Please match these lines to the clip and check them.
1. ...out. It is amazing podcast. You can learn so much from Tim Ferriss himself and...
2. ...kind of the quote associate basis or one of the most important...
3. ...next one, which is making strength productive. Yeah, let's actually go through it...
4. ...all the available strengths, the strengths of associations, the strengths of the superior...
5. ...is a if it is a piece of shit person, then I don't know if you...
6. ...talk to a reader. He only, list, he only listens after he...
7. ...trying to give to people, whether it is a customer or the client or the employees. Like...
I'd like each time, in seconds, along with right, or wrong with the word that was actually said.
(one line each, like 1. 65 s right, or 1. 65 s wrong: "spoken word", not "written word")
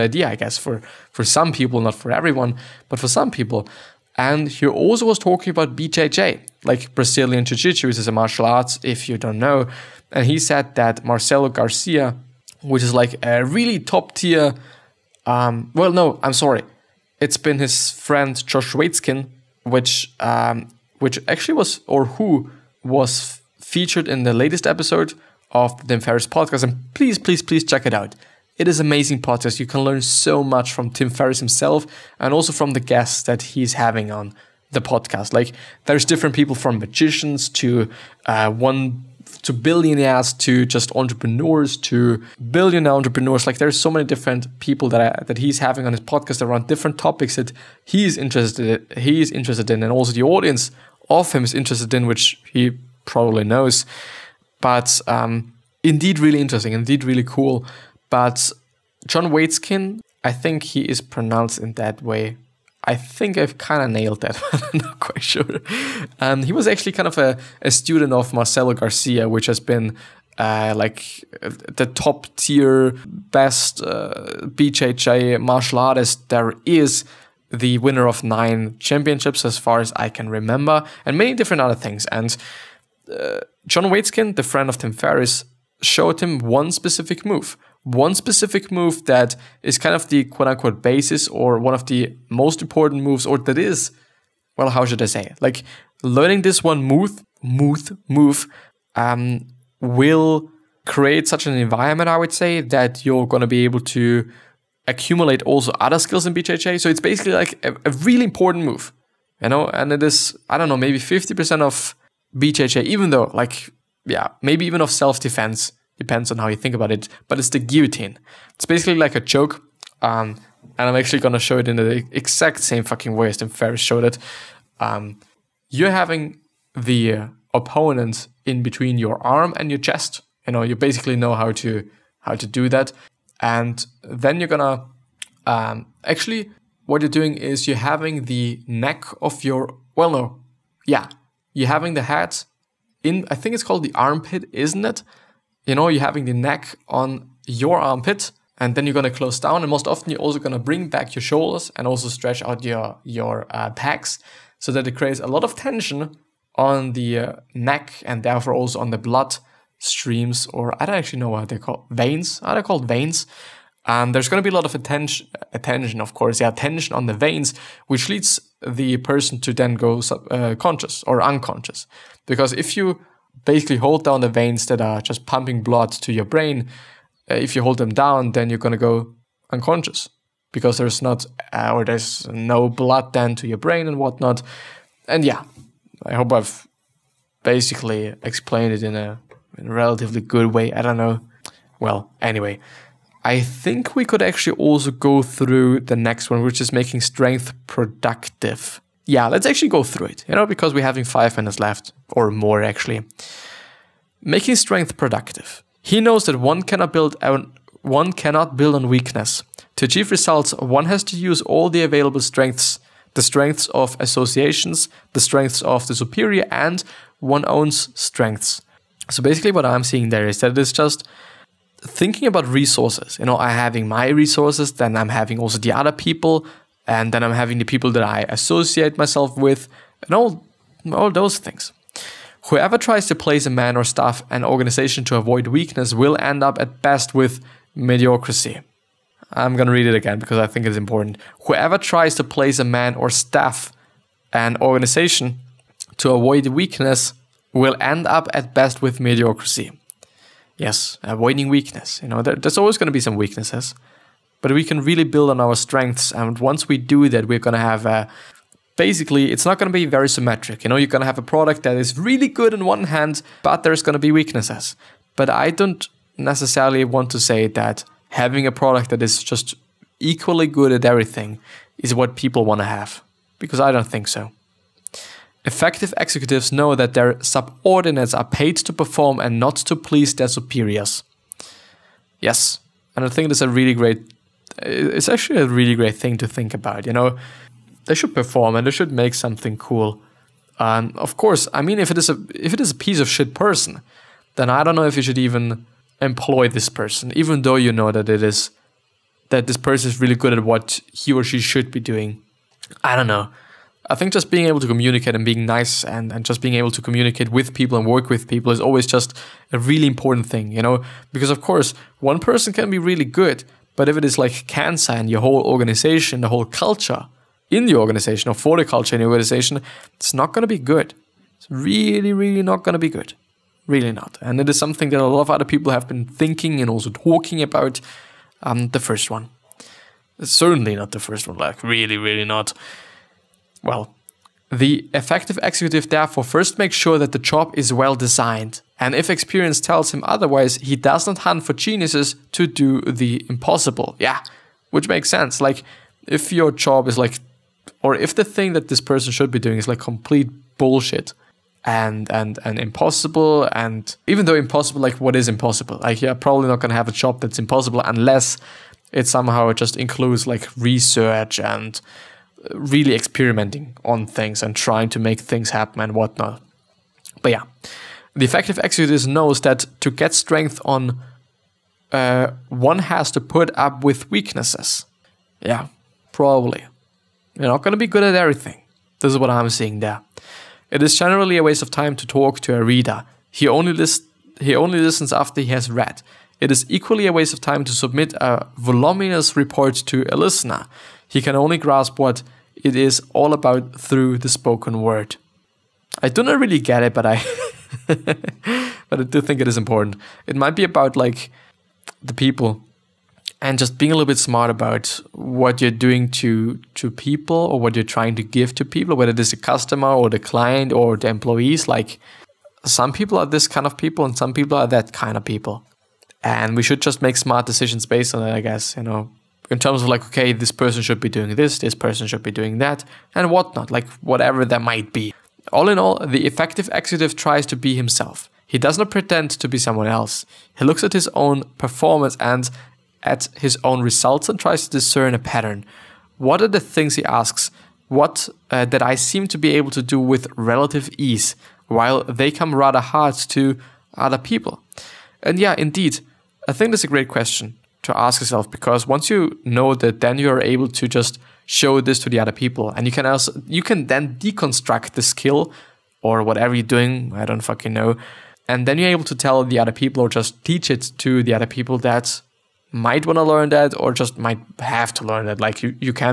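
1. 27 s right
2. 89 s wrong: "unquote", not "associate"
3. 195 s right
4. 211 s right
5. 291 s right
6. 382 s right
7. 407 s right.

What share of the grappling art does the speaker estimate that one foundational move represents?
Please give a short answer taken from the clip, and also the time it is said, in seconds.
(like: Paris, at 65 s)
50%, at 110 s.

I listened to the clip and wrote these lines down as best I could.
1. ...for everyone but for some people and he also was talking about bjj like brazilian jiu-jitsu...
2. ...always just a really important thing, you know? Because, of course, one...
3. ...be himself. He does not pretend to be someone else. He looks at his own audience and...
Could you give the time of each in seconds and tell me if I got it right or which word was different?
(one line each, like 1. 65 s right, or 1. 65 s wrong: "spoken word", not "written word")
1. 1 s right
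2. 308 s right
3. 427 s wrong: "performance", not "audience".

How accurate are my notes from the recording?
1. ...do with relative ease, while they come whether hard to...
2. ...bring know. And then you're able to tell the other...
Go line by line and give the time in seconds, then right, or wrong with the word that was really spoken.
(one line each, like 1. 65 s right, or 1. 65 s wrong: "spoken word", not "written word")
1. 439 s wrong: "rather", not "whether"
2. 457 s wrong: "fucking", not "bring".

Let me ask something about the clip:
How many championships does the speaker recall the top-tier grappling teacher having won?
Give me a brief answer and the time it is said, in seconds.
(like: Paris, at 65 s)
9, at 78 s.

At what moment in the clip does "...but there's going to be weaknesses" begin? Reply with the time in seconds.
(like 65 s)
263 s.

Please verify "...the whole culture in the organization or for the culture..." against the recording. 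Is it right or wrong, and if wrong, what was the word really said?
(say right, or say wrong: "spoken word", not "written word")
right.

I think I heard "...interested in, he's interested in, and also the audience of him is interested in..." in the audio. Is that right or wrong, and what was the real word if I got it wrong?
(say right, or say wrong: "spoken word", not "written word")
right.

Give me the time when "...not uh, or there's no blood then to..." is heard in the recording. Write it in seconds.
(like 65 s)
181 s.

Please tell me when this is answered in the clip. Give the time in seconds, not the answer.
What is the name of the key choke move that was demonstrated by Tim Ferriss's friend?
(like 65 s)
117 s.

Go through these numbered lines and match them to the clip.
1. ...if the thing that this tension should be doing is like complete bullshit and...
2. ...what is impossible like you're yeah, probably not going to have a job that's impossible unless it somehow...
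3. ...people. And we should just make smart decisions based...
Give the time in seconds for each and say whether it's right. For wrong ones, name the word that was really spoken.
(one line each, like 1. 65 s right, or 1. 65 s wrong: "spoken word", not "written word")
1. 347 s wrong: "person", not "tension"
2. 354 s right
3. 415 s right.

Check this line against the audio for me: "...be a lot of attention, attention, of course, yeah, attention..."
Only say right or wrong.
right.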